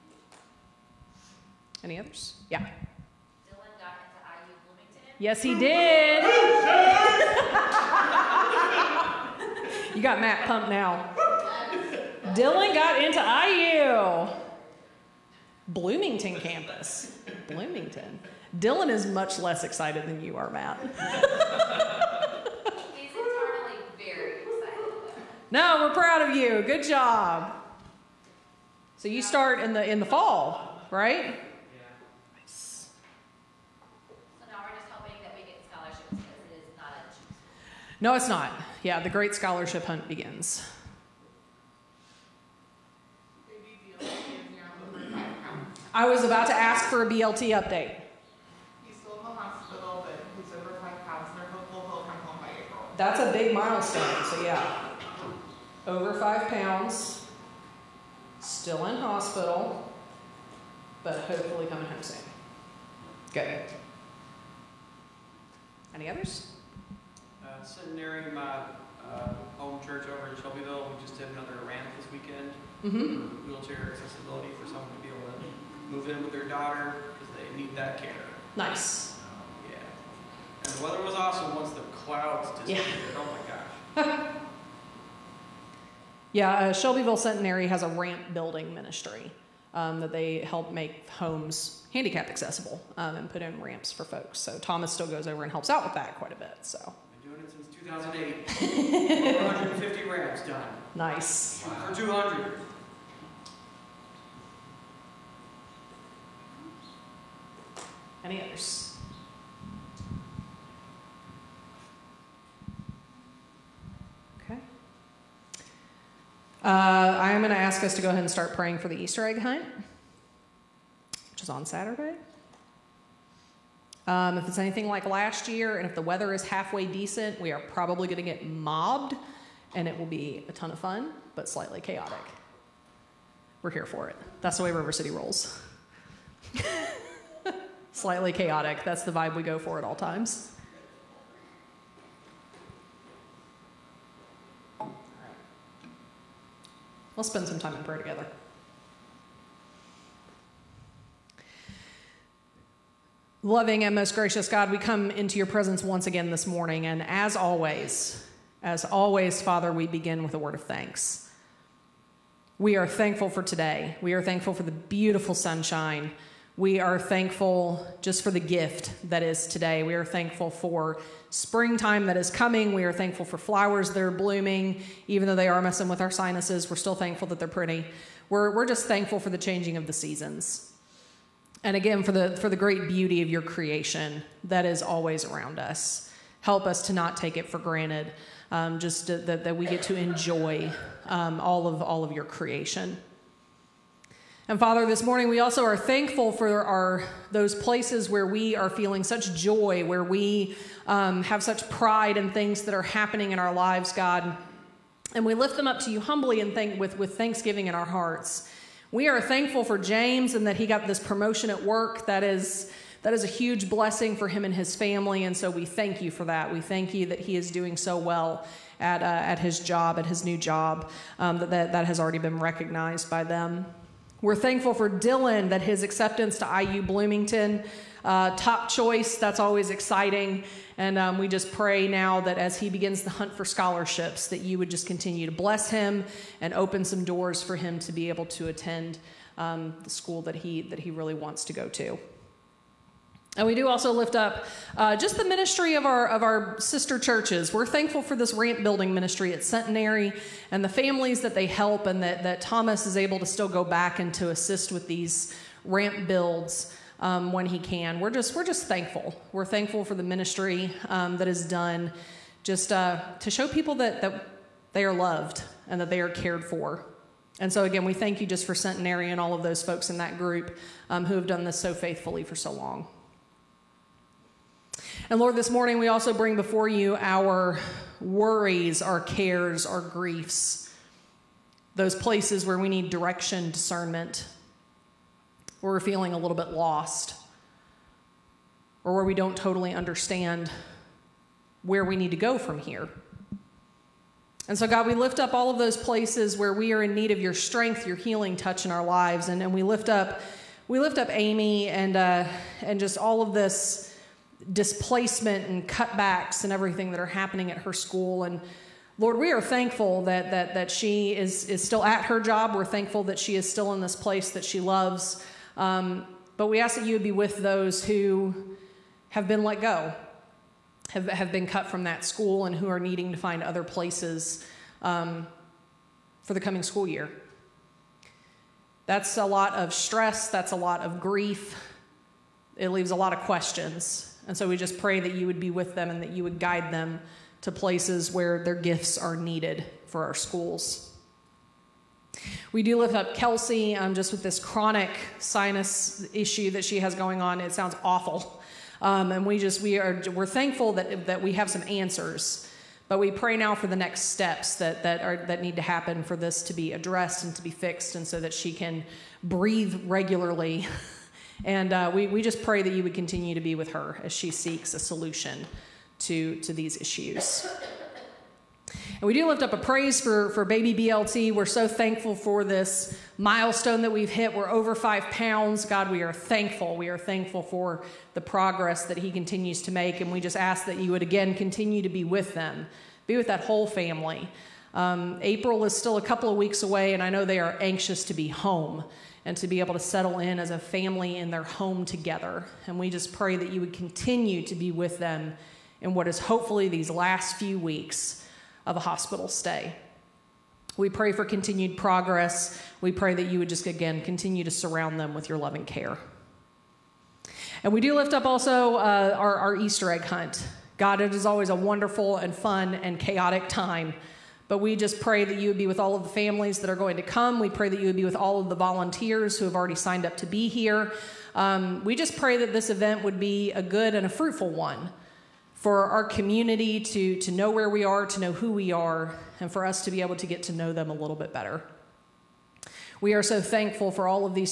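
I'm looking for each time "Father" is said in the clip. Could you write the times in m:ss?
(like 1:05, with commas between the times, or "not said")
2:39, 3:14.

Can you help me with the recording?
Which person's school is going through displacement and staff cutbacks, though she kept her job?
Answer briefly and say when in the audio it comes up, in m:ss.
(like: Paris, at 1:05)
Amy, at 5:01.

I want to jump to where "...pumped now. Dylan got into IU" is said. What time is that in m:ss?
0:10.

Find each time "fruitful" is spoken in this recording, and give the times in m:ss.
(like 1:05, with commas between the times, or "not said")
7:04.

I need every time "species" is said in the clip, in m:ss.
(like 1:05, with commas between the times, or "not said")
not said.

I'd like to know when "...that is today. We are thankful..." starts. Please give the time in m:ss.
2:49.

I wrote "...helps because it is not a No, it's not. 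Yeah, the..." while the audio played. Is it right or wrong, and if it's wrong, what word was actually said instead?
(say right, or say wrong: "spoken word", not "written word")
wrong: "scholarships", not "helps".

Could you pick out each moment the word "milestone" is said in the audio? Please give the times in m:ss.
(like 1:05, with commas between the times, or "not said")
0:53, 6:13.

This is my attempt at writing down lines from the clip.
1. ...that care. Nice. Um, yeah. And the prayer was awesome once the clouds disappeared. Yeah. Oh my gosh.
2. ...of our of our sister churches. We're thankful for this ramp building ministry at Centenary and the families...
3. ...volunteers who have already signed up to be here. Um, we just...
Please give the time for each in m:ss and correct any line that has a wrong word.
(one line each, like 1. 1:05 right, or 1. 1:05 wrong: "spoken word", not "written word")
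1. 1:17 wrong: "weather", not "prayer"
2. 4:05 right
3. 6:58 right.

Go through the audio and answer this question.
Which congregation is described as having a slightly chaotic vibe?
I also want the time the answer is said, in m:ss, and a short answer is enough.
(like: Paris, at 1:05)
River City, at 2:14.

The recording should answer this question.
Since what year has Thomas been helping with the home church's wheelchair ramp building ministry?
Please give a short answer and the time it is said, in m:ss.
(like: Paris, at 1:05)
2008, at 1:38.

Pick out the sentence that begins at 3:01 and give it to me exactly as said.
And again, for the, for the great beauty of your creation that is always around us.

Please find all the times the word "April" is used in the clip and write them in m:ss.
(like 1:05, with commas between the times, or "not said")
0:52, 6:25.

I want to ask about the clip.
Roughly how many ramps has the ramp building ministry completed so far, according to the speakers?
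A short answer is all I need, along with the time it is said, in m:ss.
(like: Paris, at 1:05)
150, at 1:39.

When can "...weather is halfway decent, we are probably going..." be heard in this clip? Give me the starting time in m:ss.
2:06.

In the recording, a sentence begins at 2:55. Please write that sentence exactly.
Even though they are messing with our sinuses, we're still thankful that they're pretty.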